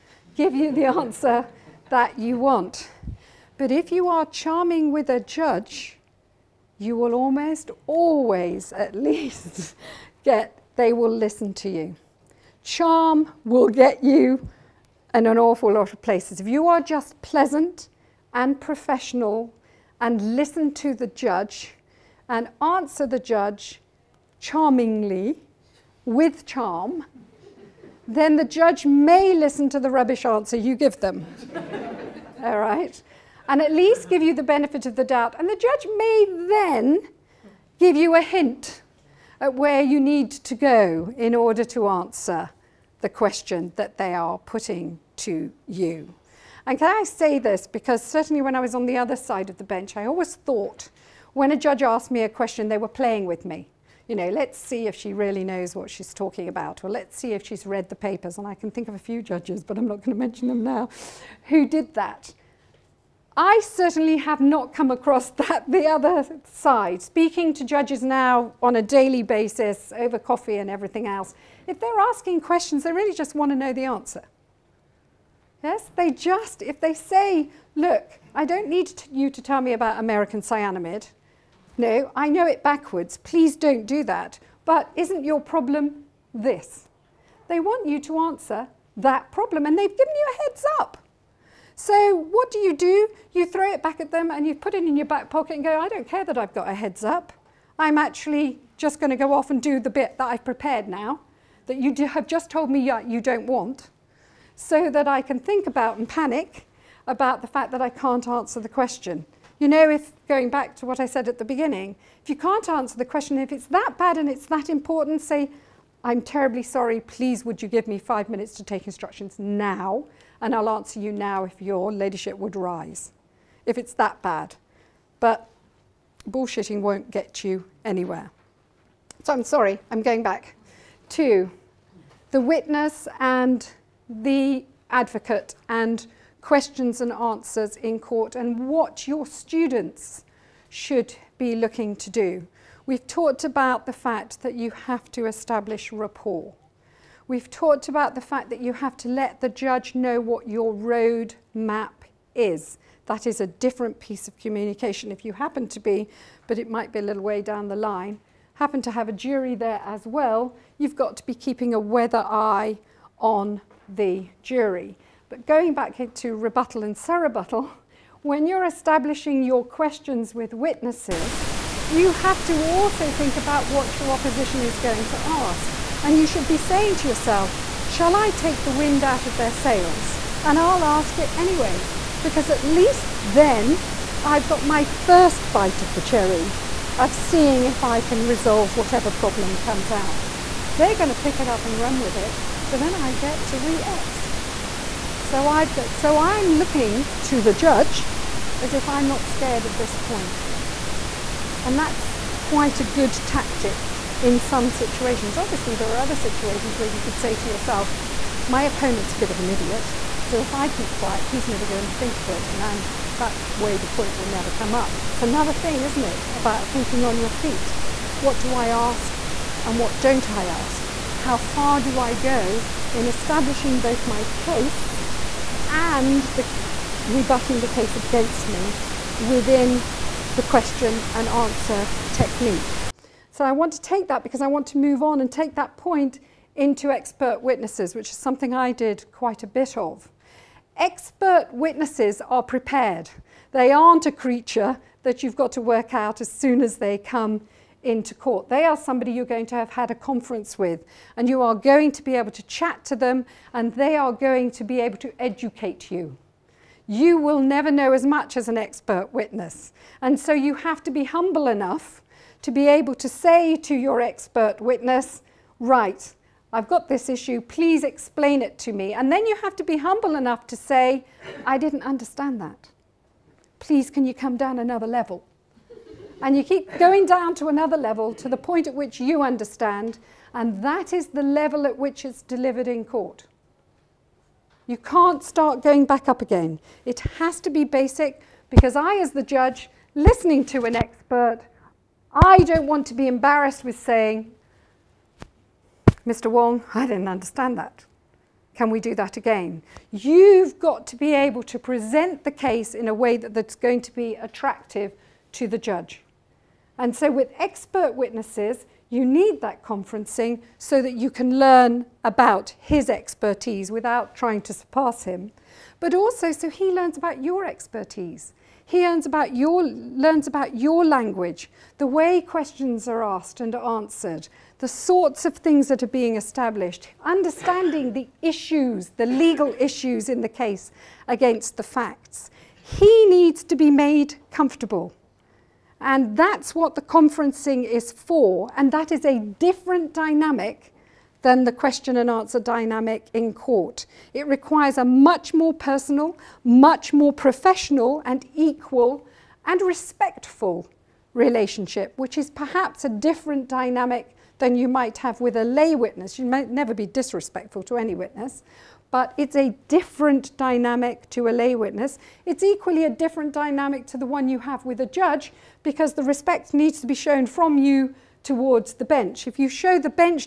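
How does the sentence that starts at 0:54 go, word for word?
You know, let's see if she really knows what she's talking about, or let's see if she's read the papers.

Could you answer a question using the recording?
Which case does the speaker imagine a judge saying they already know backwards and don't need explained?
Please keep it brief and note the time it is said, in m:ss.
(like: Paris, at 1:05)
American Cyanamid, at 1:19.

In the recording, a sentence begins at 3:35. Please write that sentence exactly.
It's another thing, isn't it, about thinking on your feet.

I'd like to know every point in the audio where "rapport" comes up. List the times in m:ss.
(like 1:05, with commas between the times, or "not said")
2:25.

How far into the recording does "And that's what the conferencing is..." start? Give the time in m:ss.
5:35.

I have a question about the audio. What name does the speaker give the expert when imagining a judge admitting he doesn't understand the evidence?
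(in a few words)
Mr. Wong.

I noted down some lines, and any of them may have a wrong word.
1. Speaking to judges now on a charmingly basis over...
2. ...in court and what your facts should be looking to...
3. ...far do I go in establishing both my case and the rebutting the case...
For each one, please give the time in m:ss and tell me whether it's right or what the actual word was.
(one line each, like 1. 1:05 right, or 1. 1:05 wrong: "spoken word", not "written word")
1. 1:07 wrong: "daily", not "charmingly"
2. 2:17 wrong: "students", not "facts"
3. 3:41 right.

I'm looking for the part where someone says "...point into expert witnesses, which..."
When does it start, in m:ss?
3:55.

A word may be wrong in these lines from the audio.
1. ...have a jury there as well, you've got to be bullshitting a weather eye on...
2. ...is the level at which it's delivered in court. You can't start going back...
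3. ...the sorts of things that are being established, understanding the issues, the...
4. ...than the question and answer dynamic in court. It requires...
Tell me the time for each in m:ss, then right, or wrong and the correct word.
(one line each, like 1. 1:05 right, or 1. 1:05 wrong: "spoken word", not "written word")
1. 2:38 wrong: "keeping", not "bullshitting"
2. 4:40 right
3. 5:24 right
4. 5:41 right.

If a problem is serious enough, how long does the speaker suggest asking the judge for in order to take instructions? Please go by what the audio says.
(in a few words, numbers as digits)
5 minutes.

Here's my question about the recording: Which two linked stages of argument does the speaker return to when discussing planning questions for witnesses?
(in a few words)
Rebuttal and surrebuttal.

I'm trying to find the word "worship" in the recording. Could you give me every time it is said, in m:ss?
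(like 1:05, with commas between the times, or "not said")
not said.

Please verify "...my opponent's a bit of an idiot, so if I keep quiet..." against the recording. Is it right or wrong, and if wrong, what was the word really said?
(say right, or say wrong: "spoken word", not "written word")
right.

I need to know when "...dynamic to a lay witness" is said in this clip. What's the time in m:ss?
6:00.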